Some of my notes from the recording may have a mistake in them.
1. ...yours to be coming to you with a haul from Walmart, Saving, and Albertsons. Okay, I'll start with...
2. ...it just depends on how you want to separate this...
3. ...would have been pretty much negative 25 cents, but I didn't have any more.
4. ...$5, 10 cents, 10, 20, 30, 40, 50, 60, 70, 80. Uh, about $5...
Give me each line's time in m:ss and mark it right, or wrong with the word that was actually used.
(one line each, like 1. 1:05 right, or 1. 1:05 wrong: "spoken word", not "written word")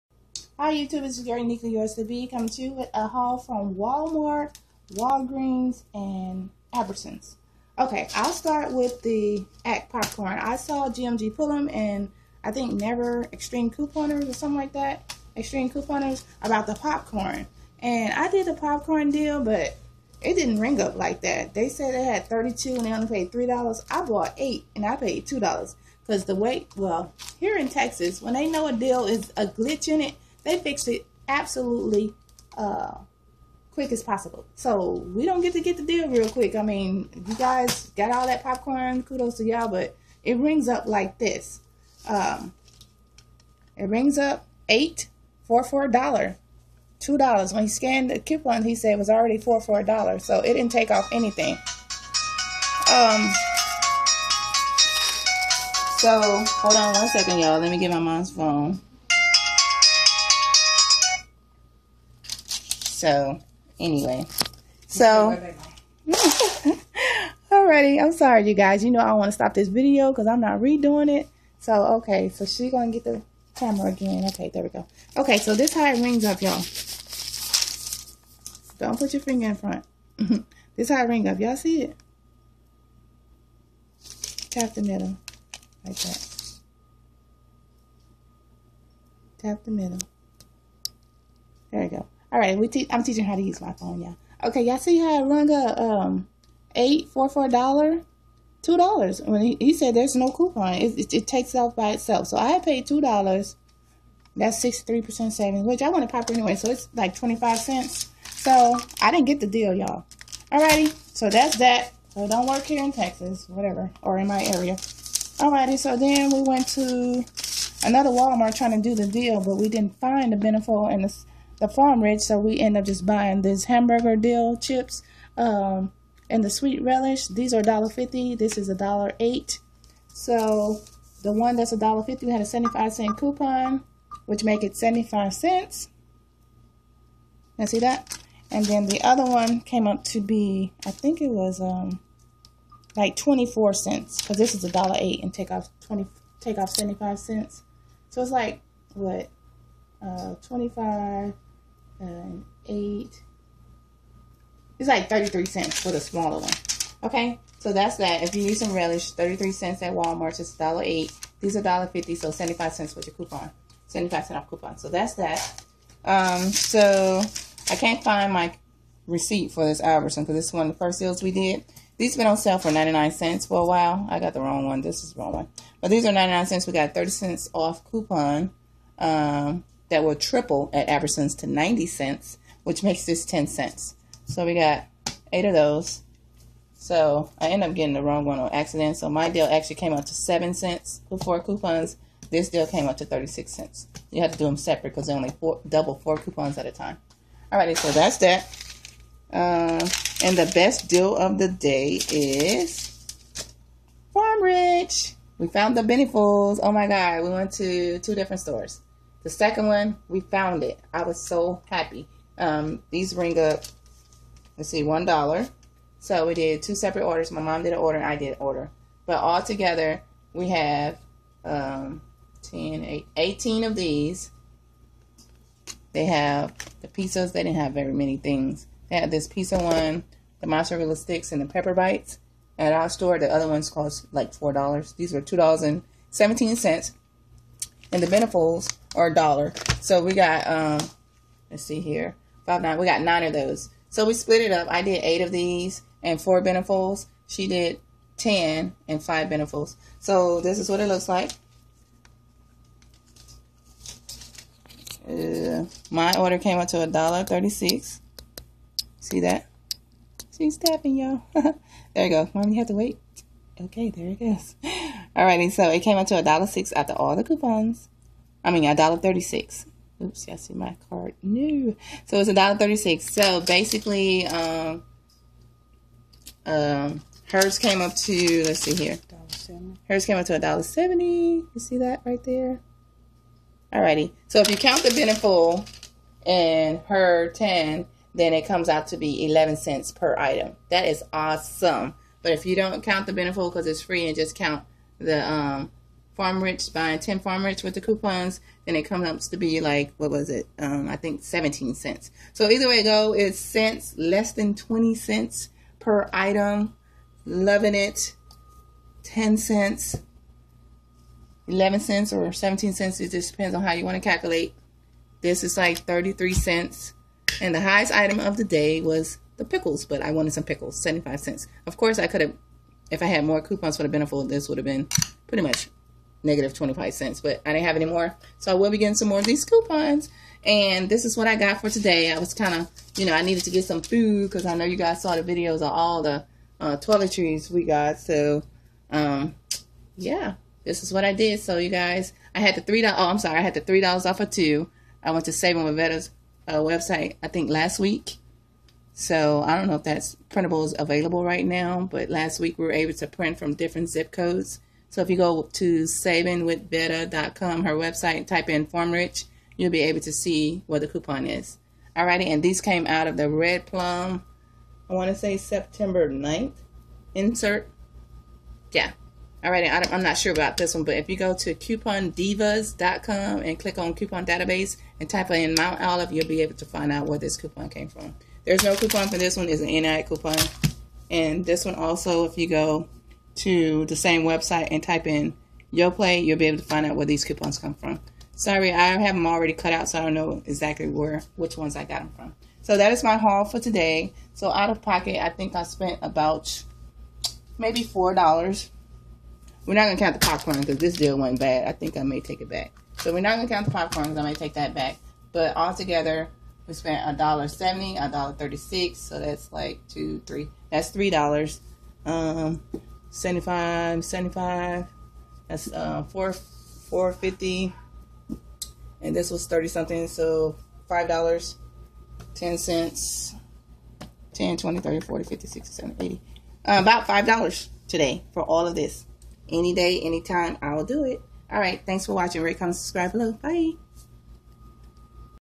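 1. 0:01 wrong: "Walgreens", not "Saving"
2. 5:12 wrong: "calculate", not "separate"
3. 5:24 right
4. 7:00 right.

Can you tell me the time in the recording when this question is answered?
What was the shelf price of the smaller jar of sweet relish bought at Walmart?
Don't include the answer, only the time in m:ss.
2:08.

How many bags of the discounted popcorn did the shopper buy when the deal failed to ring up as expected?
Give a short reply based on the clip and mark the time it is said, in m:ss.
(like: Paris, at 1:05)
8, at 0:23.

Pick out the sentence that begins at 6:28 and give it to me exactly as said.
Sorry, I have them already cut out, so I don't know exactly where which ones I got them from.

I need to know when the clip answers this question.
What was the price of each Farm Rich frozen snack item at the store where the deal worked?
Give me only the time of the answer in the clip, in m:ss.
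3:54.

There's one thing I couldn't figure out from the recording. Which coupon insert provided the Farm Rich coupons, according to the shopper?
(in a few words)
Red Plum.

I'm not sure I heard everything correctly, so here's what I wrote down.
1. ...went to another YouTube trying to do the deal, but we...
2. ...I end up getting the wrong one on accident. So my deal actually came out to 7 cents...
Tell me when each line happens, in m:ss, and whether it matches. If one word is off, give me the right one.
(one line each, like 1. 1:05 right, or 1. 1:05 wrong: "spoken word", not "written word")
1. 1:56 wrong: "Walmart", not "YouTube"
2. 3:07 right.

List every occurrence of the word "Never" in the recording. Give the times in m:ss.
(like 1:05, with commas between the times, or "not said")
0:12.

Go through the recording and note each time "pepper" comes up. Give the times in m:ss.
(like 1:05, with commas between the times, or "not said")
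3:51.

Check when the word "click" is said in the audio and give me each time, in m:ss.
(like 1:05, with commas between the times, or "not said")
6:13.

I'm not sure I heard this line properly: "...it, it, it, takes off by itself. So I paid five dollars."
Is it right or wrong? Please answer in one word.
wrong.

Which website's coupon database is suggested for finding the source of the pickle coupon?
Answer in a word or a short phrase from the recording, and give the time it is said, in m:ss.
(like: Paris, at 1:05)
coupondivas.com, at 6:11.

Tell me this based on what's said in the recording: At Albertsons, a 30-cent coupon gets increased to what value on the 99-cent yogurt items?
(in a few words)
90 cents.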